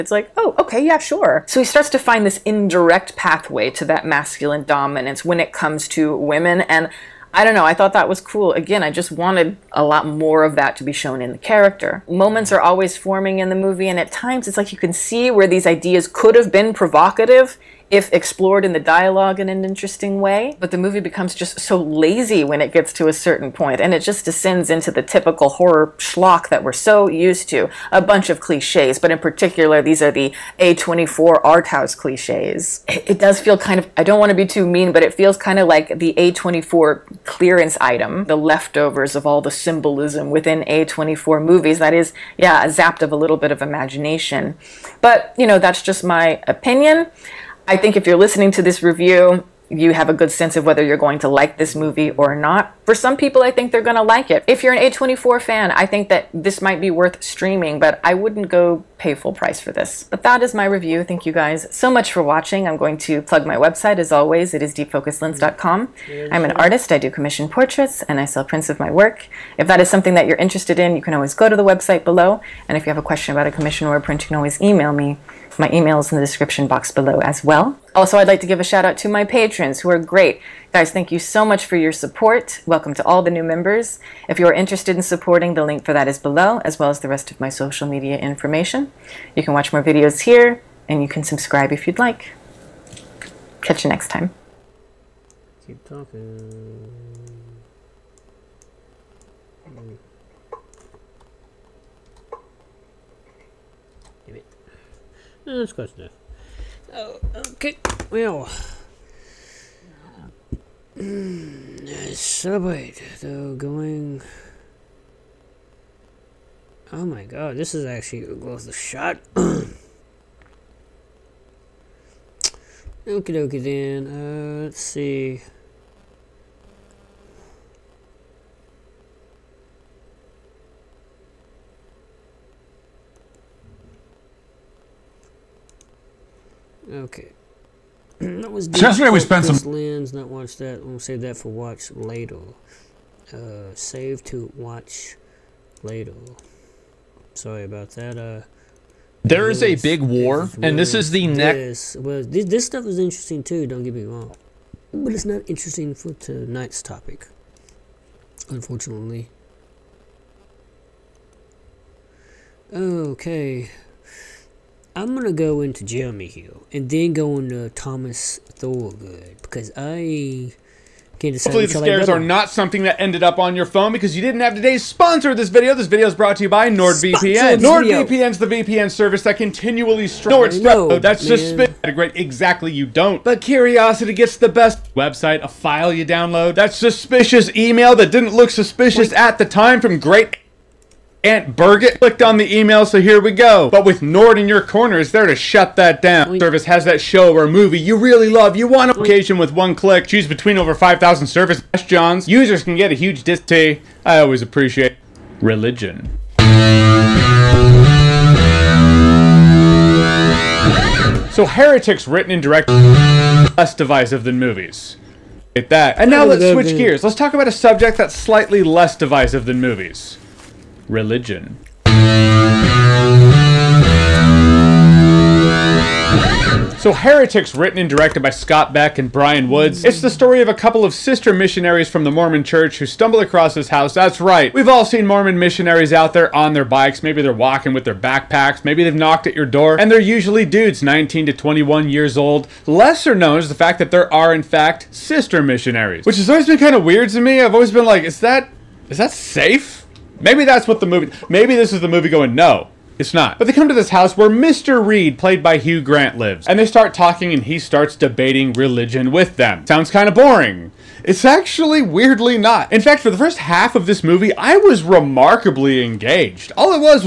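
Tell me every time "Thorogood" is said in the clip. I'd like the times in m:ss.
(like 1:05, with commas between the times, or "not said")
2:48.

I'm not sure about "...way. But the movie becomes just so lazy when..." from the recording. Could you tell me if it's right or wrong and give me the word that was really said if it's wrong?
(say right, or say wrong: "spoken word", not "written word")
right.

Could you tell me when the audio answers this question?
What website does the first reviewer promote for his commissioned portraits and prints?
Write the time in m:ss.
1:04.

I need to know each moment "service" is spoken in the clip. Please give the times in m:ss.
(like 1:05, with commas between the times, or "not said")
2:58, 3:16, 3:21.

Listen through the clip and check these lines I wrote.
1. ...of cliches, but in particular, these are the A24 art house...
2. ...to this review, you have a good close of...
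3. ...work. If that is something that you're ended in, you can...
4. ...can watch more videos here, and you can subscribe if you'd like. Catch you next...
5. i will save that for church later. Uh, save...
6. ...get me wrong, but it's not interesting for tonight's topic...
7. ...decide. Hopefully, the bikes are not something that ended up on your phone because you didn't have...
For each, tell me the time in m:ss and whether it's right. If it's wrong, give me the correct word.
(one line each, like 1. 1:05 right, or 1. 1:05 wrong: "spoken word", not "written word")
1. 0:28 right
2. 0:48 wrong: "sense", not "close"
3. 1:08 wrong: "interested", not "ended"
4. 1:29 right
5. 2:20 wrong: "watch", not "church"
6. 2:33 right
7. 2:51 wrong: "scares", not "bikes".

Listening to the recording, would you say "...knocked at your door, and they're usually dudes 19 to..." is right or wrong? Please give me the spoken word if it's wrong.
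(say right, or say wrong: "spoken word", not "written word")
right.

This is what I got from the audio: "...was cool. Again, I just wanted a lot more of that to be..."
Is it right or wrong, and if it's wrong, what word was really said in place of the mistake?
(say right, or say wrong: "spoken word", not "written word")
right.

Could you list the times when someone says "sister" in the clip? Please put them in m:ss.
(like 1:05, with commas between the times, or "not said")
3:50, 4:04.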